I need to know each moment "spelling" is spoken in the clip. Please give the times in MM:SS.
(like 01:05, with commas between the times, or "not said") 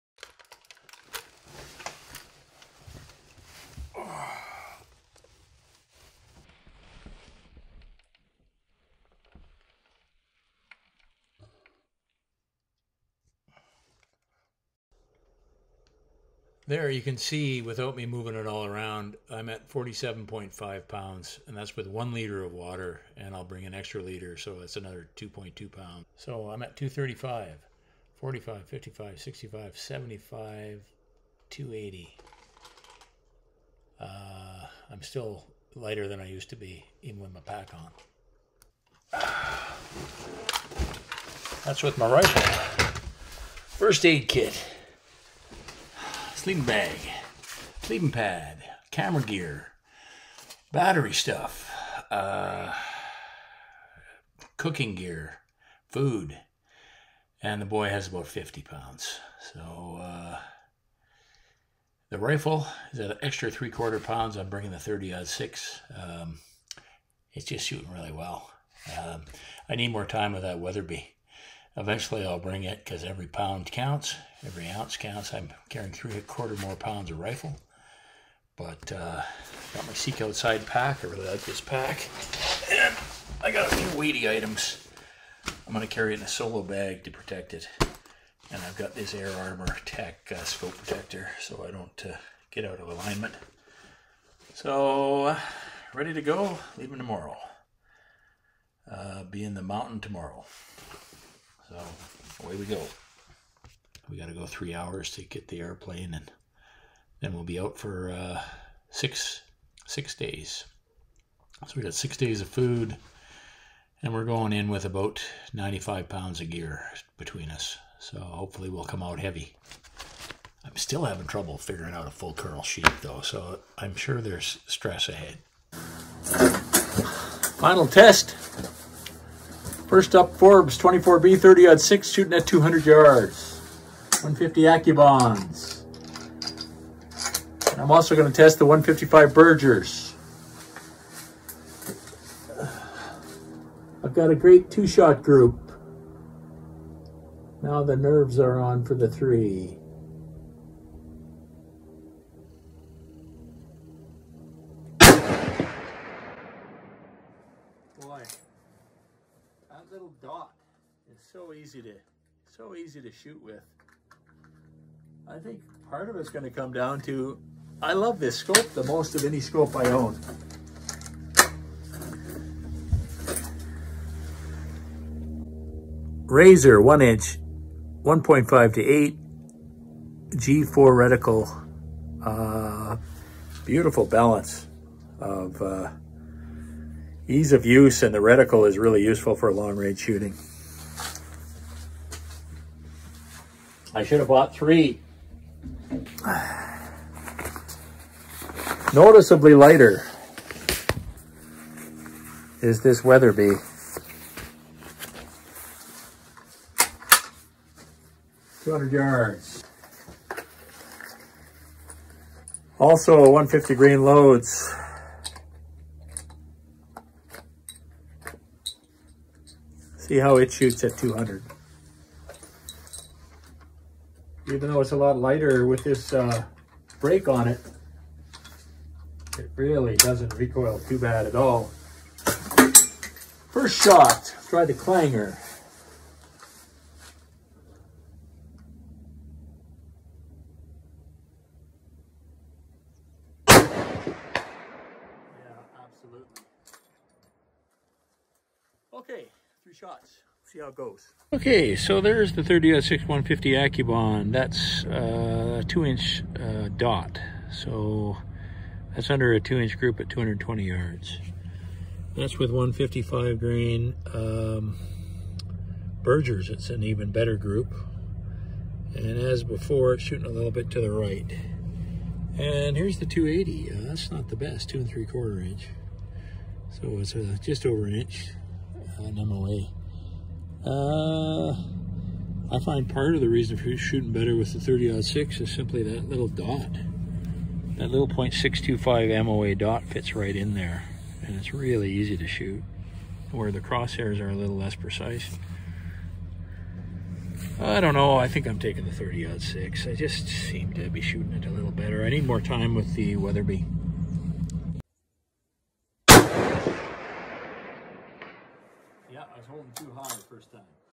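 not said.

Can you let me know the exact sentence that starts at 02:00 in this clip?
I'm still having trouble figuring out a full curl sheep, though, so I'm sure there's stress ahead.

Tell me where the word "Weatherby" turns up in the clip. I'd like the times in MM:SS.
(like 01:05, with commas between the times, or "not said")
01:10, 03:23, 05:03.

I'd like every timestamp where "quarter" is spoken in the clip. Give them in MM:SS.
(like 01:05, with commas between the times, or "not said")
01:03, 01:16, 04:35.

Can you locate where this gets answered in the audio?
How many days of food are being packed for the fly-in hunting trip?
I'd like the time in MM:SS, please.
01:51.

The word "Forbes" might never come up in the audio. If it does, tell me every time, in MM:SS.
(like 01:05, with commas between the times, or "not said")
02:10.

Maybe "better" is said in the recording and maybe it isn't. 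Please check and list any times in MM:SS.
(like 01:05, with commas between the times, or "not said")
04:27, 04:44, 05:01.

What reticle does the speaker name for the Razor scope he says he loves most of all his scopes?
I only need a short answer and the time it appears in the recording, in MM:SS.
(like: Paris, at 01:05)
G4, at 03:00.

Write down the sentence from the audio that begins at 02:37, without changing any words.
Boy that little dot is so easy to so easy to shoot with.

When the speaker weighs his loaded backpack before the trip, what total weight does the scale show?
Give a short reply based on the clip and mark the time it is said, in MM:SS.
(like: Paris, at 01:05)
47.5 pounds, at 00:19.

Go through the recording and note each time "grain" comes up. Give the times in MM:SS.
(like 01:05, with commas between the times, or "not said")
03:33, 04:23.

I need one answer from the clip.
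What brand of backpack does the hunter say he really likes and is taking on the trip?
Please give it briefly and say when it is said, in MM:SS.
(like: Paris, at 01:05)
Seek Outside, at 01:19.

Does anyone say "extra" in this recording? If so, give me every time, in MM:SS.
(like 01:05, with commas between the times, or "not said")
00:23, 01:03.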